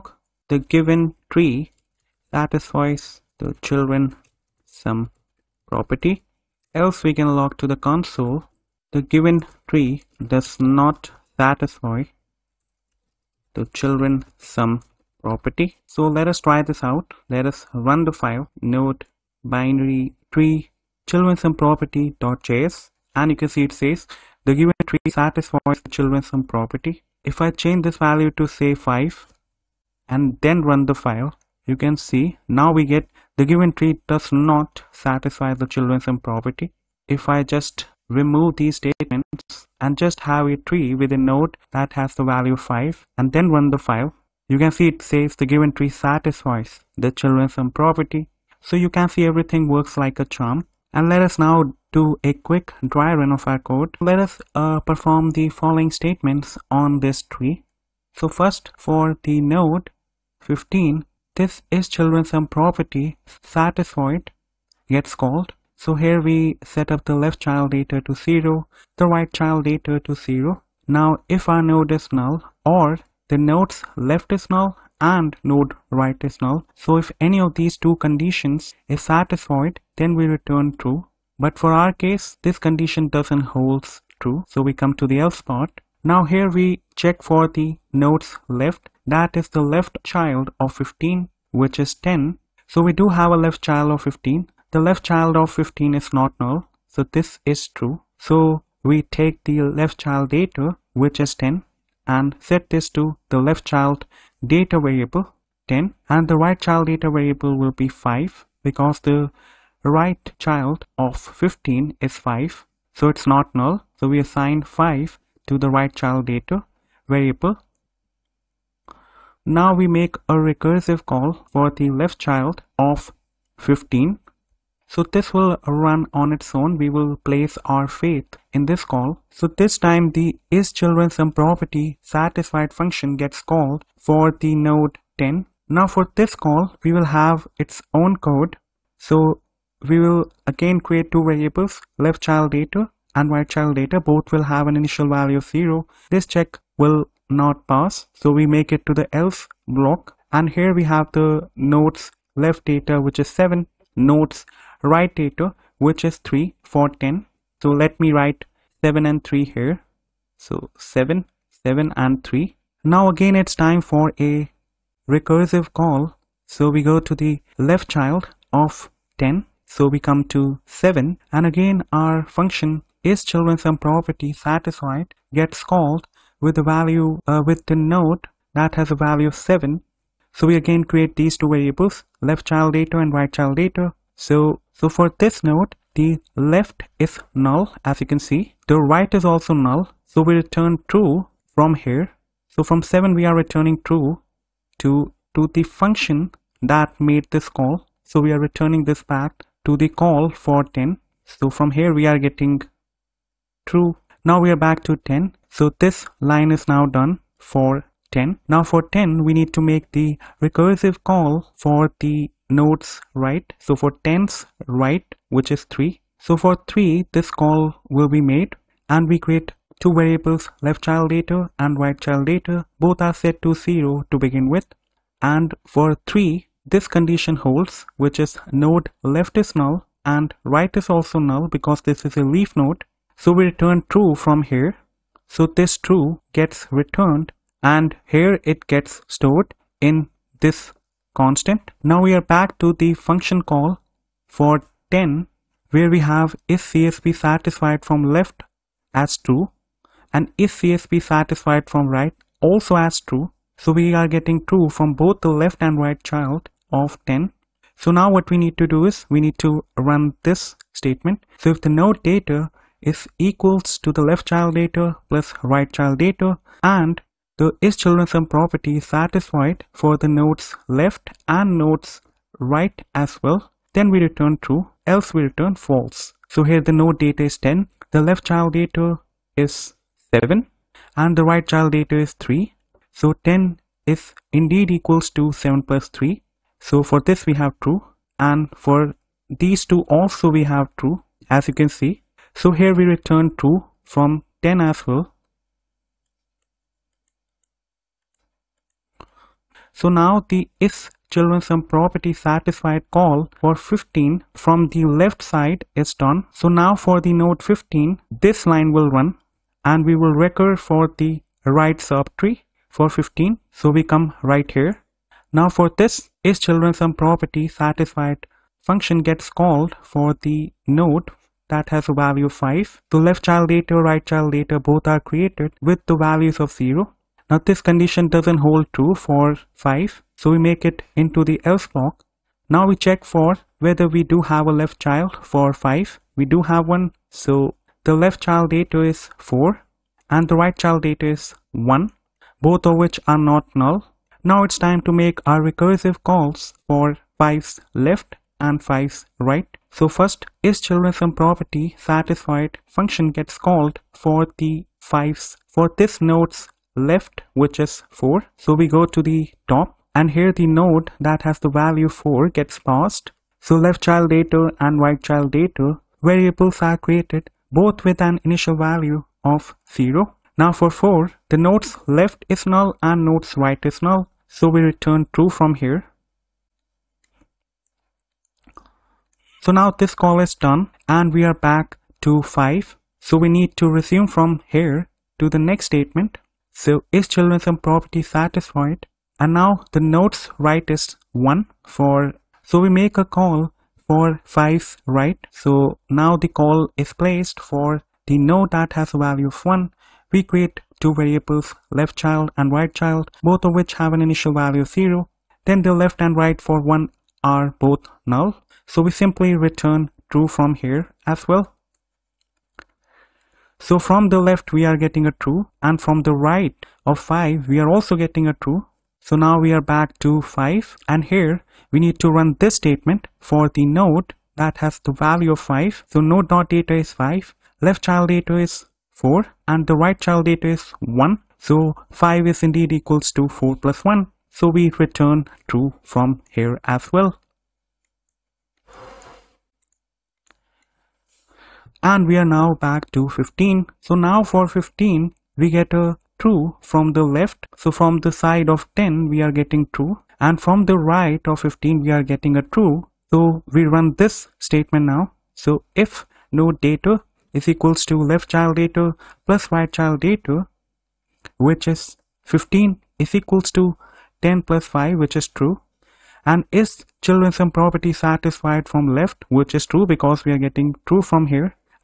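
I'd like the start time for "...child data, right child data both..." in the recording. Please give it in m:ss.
5:23.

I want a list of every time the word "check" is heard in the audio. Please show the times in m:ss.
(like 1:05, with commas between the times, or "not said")
1:26, 2:26, 5:32.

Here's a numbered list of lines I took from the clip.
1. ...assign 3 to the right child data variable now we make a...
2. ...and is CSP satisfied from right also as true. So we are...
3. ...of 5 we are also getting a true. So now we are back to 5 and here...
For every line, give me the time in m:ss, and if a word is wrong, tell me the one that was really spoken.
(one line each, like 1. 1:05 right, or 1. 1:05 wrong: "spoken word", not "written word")
1. 1:54 wrong: "5", not "3"
2. 4:10 right
3. 6:56 right.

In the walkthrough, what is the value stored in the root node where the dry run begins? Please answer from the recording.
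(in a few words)
15.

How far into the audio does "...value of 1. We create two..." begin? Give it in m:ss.
6:38.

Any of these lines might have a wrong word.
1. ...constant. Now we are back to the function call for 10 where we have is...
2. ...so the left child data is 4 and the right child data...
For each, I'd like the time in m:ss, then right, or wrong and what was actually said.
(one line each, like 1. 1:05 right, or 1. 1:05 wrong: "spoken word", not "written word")
1. 4:01 right
2. 5:37 right.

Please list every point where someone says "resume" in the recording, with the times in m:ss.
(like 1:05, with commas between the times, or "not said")
6:23.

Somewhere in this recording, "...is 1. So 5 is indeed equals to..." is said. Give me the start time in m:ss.
7:10.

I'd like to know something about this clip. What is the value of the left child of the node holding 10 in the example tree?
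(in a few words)
7.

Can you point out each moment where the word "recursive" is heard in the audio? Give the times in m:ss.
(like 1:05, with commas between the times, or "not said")
2:00, 2:45, 3:30, 5:45.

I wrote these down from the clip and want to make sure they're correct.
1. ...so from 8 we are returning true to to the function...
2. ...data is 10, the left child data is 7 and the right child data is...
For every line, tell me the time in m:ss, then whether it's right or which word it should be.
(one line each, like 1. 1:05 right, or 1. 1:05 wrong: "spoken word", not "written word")
1. 3:12 wrong: "7", not "8"
2. 4:36 right.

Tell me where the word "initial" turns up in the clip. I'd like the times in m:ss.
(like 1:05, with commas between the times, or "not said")
2:24, 6:08, 6:44.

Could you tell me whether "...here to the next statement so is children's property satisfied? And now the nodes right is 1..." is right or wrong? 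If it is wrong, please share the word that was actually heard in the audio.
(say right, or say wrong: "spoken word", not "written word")
right.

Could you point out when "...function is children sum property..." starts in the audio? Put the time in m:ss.
2:52.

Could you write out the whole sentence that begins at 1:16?
So if any of these two conditions is satisfied, then we return true.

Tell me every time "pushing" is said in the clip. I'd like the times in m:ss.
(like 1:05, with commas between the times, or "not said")
not said.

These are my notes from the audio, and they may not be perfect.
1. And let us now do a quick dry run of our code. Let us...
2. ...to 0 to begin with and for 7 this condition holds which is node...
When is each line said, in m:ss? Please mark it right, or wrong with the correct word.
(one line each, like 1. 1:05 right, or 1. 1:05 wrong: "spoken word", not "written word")
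1. 0:50 right
2. 3:43 wrong: "3", not "7".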